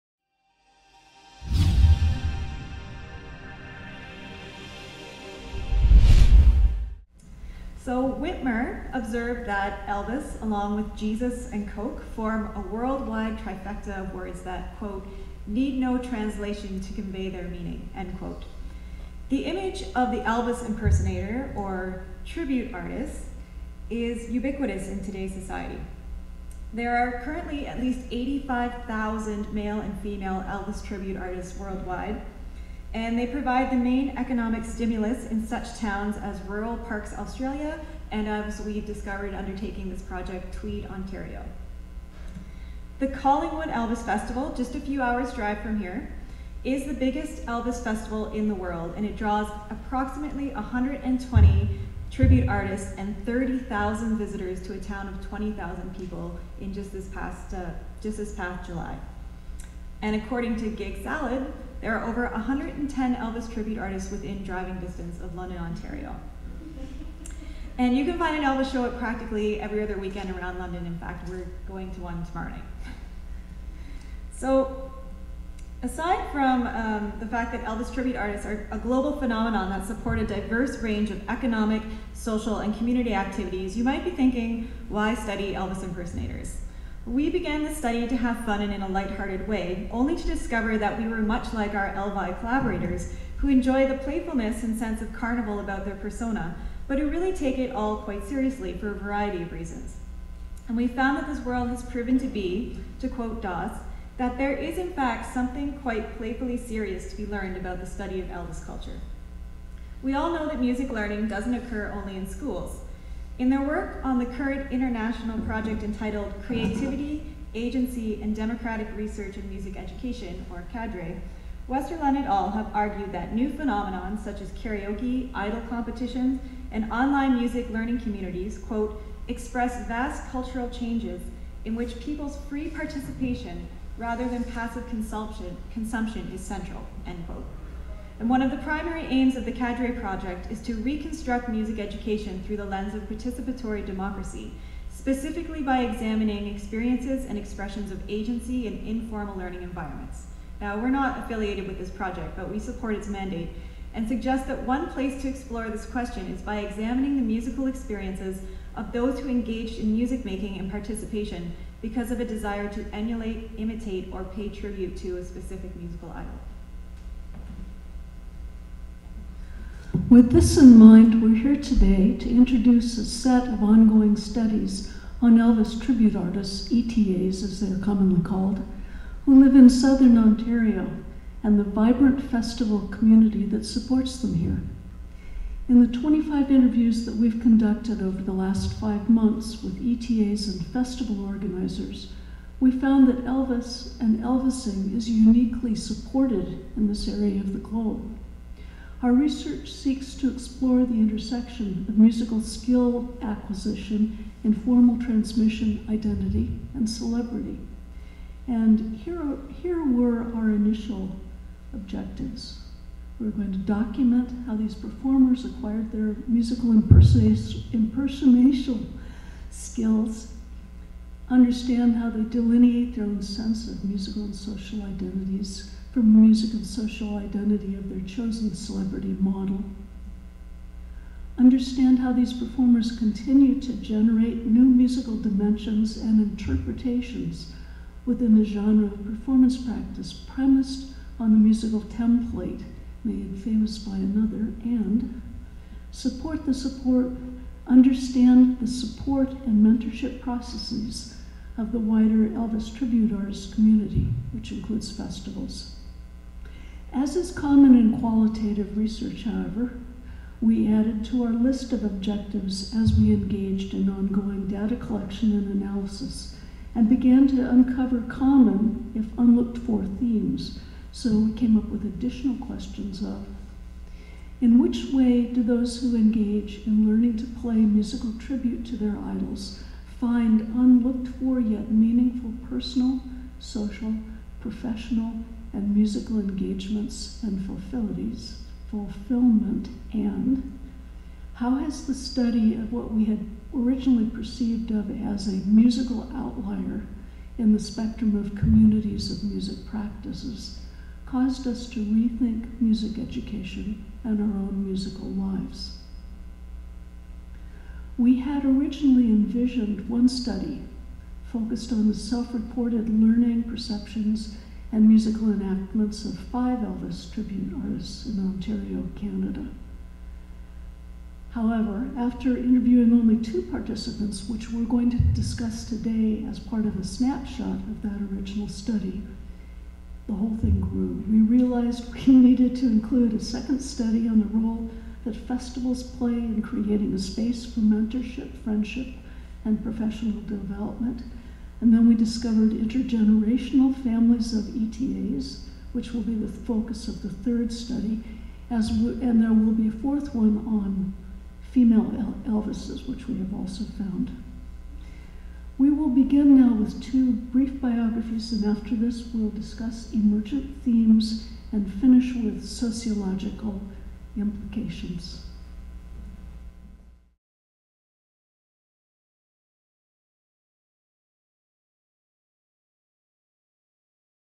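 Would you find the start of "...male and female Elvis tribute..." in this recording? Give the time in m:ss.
0:29.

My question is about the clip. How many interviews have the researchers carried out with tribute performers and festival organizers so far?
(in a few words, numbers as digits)
25.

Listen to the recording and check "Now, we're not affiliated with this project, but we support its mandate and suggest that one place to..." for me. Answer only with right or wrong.
right.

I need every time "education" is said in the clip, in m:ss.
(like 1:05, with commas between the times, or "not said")
1:59, 2:21, 5:02.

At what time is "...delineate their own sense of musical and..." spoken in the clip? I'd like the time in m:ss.
3:42.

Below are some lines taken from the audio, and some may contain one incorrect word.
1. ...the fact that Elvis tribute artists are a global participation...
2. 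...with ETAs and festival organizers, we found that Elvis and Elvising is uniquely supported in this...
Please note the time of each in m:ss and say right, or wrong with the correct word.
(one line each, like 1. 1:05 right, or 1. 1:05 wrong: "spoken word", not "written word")
1. 1:17 wrong: "phenomenon", not "participation"
2. 3:09 right.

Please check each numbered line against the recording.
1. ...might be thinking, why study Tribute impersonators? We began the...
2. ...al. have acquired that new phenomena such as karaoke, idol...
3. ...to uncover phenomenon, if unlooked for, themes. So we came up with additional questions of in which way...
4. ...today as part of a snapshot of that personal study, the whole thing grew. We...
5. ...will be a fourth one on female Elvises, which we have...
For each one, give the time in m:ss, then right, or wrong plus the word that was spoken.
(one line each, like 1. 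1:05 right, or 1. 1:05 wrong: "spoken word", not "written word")
1. 1:23 wrong: "Elvis", not "Tribute"
2. 2:02 wrong: "argued", not "acquired"
3. 4:27 wrong: "common", not "phenomenon"
4. 5:25 wrong: "original", not "personal"
5. 5:49 right.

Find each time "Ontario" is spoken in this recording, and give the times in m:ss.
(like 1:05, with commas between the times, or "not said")
0:40, 1:05, 3:00, 5:18.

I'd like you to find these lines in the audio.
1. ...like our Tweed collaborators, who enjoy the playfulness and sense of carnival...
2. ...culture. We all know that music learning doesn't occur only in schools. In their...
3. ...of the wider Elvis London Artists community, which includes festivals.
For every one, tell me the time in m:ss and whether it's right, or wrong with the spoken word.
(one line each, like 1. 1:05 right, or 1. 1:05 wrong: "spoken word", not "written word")
1. 1:31 wrong: "Elvi", not "Tweed"
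2. 1:48 right
3. 4:11 wrong: "Tribute", not "London".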